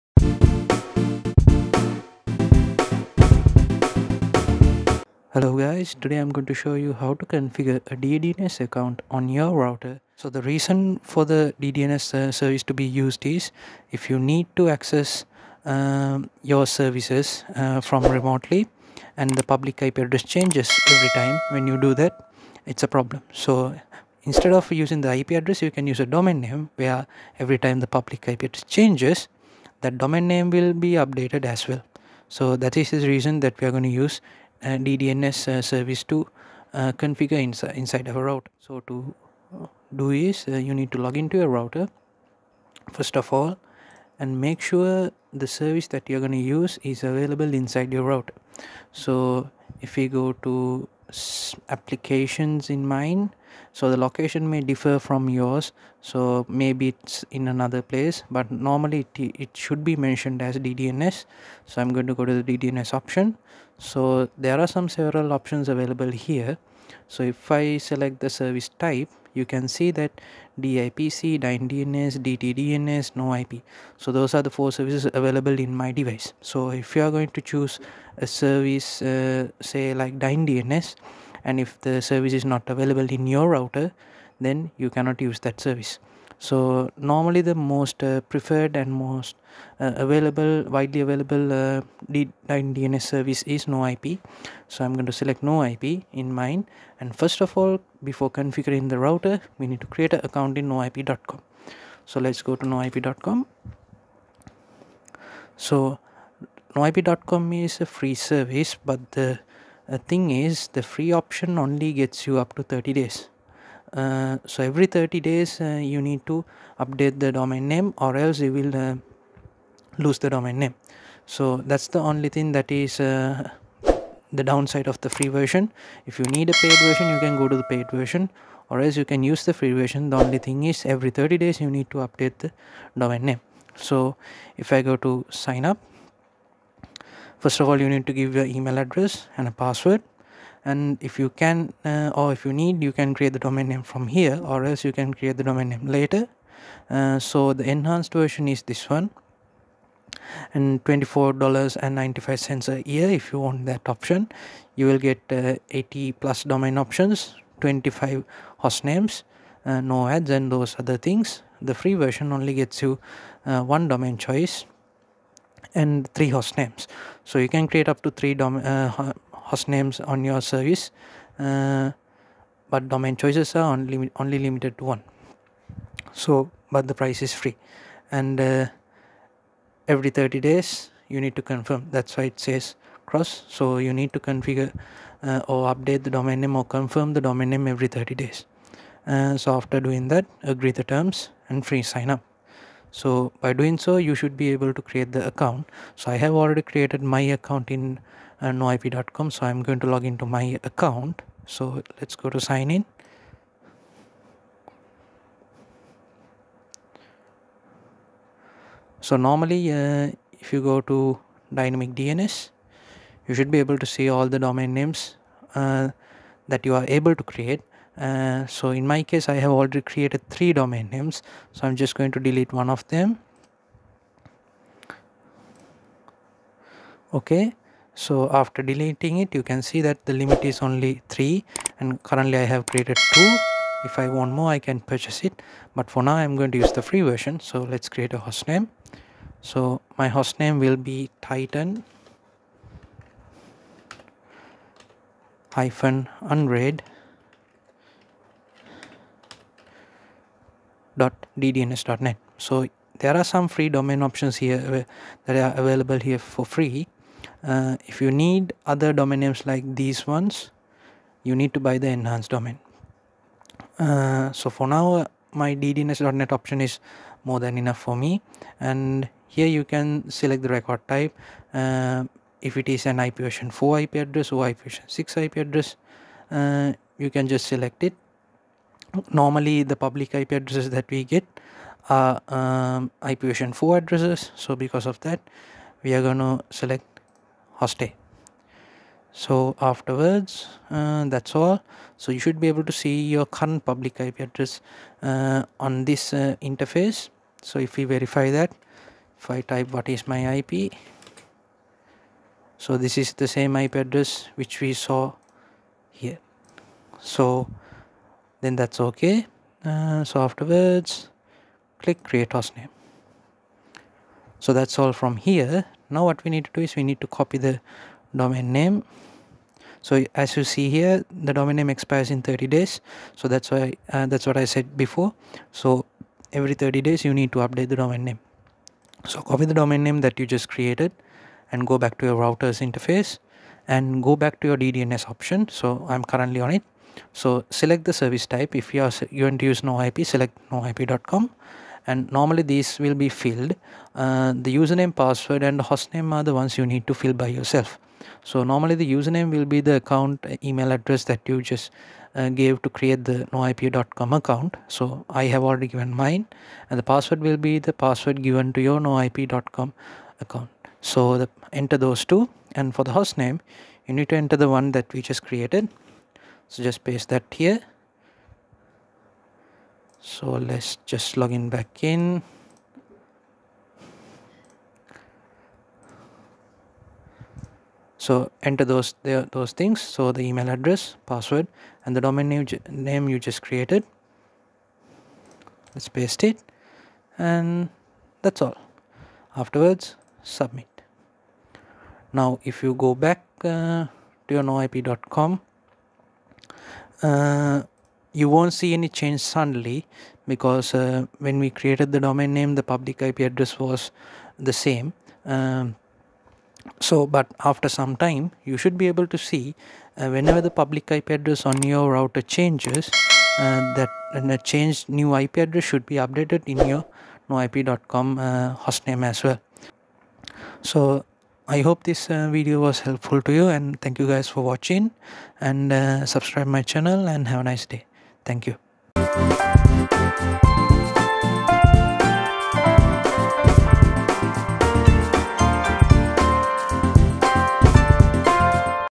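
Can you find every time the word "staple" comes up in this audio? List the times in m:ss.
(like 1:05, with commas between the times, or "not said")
not said.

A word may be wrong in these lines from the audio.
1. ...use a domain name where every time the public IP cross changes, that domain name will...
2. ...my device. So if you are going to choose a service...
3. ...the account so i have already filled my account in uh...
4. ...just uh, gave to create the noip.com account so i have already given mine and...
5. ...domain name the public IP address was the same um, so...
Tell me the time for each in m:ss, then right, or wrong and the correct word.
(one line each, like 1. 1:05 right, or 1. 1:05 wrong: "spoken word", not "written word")
1. 0:25 wrong: "address", not "cross"
2. 1:15 right
3. 3:15 wrong: "created", not "filled"
4. 5:51 right
5. 6:41 right.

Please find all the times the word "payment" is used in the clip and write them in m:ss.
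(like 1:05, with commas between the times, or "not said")
not said.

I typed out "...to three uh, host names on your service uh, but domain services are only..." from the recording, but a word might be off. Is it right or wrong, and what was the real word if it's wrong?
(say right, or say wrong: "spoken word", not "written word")
wrong: "choices", not "services".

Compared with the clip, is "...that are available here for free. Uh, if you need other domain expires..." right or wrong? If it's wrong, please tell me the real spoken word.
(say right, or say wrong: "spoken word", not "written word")
wrong: "names", not "expires".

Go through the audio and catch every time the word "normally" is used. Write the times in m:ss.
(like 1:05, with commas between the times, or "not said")
0:58, 1:26, 3:29, 4:39, 5:42, 5:48.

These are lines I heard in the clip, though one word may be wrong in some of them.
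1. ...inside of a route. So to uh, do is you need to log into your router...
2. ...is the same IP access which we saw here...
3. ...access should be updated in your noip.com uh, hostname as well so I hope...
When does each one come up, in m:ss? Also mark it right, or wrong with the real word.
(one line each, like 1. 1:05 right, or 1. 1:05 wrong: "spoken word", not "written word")
1. 0:37 right
2. 5:02 wrong: "address", not "access"
3. 6:55 wrong: "address", not "access".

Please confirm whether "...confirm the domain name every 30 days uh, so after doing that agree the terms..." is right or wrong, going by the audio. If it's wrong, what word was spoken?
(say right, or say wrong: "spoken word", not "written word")
right.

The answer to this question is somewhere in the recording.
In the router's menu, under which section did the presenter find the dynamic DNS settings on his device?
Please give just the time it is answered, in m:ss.
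0:51.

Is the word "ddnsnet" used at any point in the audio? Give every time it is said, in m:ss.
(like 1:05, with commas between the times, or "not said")
4:10, 4:25.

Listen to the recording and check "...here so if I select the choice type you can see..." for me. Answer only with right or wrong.
wrong.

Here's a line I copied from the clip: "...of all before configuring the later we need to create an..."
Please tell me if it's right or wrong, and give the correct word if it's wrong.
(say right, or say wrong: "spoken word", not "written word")
wrong: "router", not "later".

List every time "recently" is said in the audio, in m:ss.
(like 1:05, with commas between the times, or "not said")
not said.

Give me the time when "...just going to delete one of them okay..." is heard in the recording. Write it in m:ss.
3:41.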